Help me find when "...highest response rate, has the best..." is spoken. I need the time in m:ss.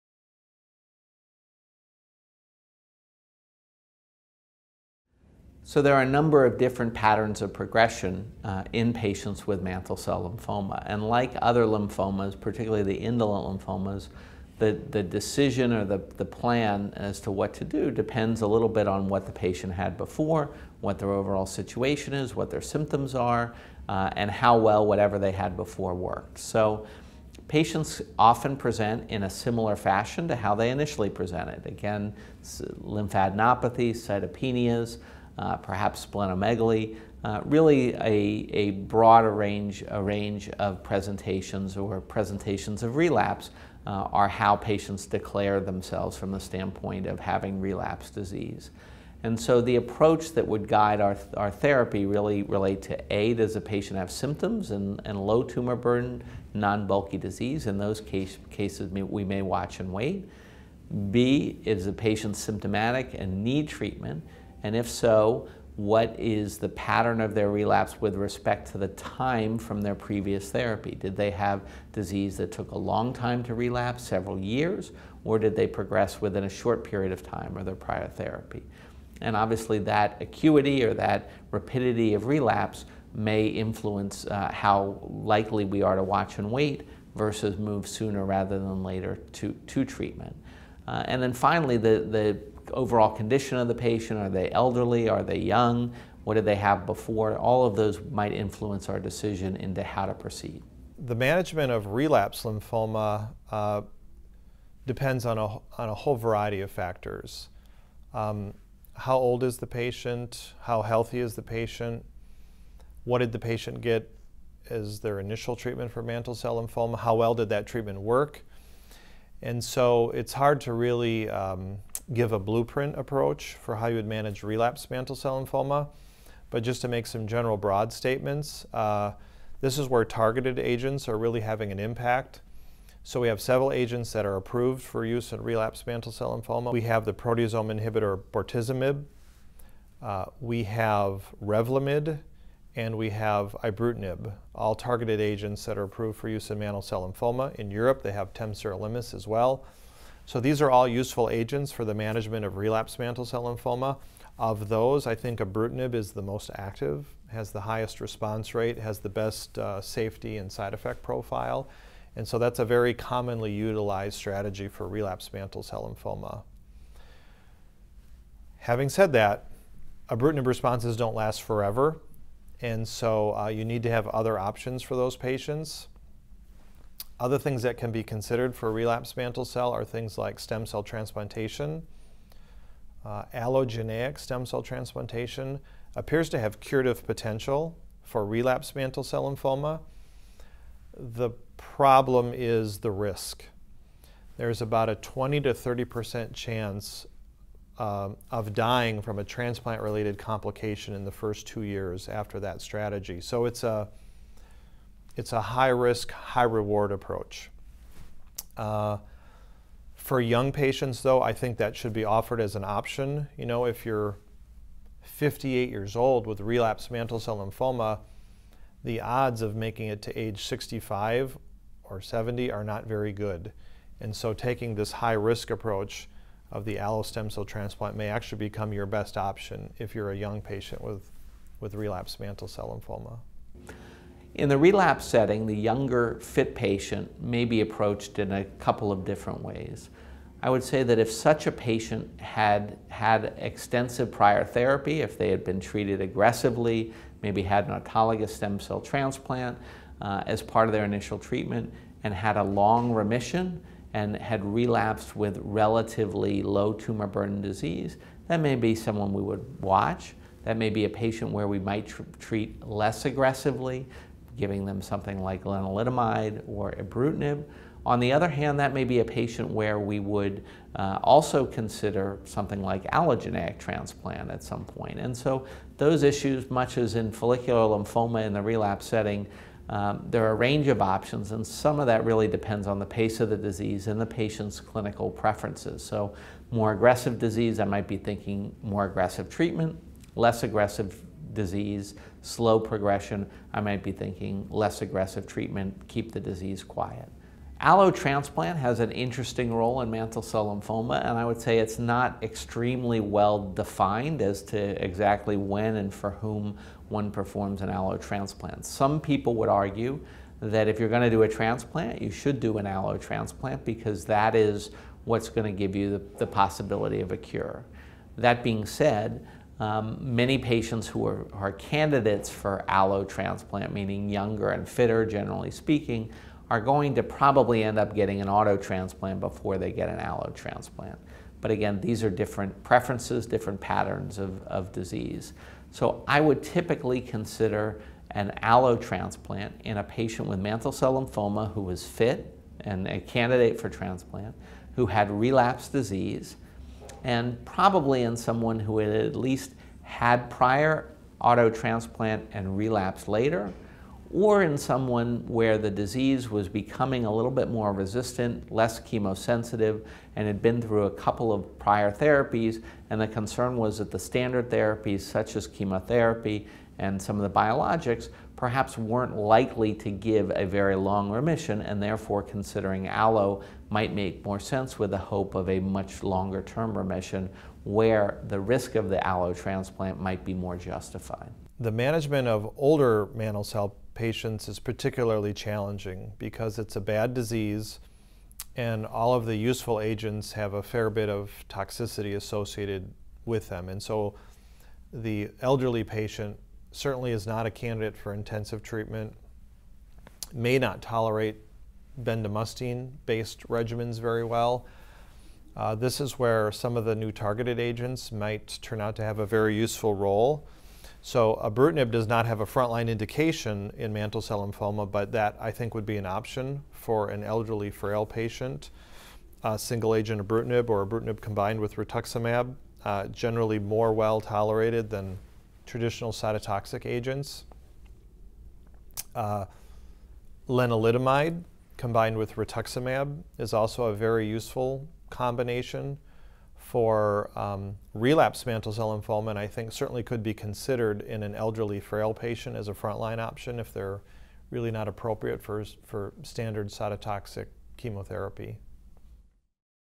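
2:37.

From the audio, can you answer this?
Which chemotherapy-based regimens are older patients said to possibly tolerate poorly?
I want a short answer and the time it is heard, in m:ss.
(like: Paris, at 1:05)
bendamustine based regimens, at 6:42.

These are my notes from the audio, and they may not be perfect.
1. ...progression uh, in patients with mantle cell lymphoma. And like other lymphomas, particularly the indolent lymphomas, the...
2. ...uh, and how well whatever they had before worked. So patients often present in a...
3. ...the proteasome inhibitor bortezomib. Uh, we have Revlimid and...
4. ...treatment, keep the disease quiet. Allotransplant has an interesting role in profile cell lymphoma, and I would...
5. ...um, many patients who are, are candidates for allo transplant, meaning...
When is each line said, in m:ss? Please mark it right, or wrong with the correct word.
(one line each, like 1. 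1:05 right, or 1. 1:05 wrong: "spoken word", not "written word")
1. 0:07 right
2. 0:23 right
3. 2:17 right
4. 4:55 wrong: "mantle", not "profile"
5. 5:19 right.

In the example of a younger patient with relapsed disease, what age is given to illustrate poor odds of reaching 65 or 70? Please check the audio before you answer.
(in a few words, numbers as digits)
58.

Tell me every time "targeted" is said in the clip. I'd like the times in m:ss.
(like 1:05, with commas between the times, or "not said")
2:10, 2:24, 6:47.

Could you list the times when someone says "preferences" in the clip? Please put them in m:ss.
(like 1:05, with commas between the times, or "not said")
4:45, 5:32.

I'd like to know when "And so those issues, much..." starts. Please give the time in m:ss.
4:34.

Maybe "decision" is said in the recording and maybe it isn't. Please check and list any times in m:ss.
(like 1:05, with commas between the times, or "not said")
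0:15, 1:38.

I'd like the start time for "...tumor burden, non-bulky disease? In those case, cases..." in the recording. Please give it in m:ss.
0:55.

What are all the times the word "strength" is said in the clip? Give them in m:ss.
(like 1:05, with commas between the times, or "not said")
not said.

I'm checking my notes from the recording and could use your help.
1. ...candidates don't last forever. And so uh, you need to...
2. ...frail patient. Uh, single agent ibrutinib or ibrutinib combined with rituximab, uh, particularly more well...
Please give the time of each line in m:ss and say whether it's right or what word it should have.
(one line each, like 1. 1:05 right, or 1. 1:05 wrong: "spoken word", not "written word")
1. 2:50 wrong: "responses", not "candidates"
2. 6:57 wrong: "generally", not "particularly".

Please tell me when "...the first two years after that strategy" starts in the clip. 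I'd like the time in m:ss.
3:21.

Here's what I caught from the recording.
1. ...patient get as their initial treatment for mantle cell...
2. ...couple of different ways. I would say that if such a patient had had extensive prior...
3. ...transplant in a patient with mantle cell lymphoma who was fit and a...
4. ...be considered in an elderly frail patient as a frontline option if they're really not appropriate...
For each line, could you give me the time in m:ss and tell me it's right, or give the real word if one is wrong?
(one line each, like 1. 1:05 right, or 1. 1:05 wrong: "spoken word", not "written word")
1. 1:53 right
2. 3:58 right
3. 5:38 right
4. 7:20 right.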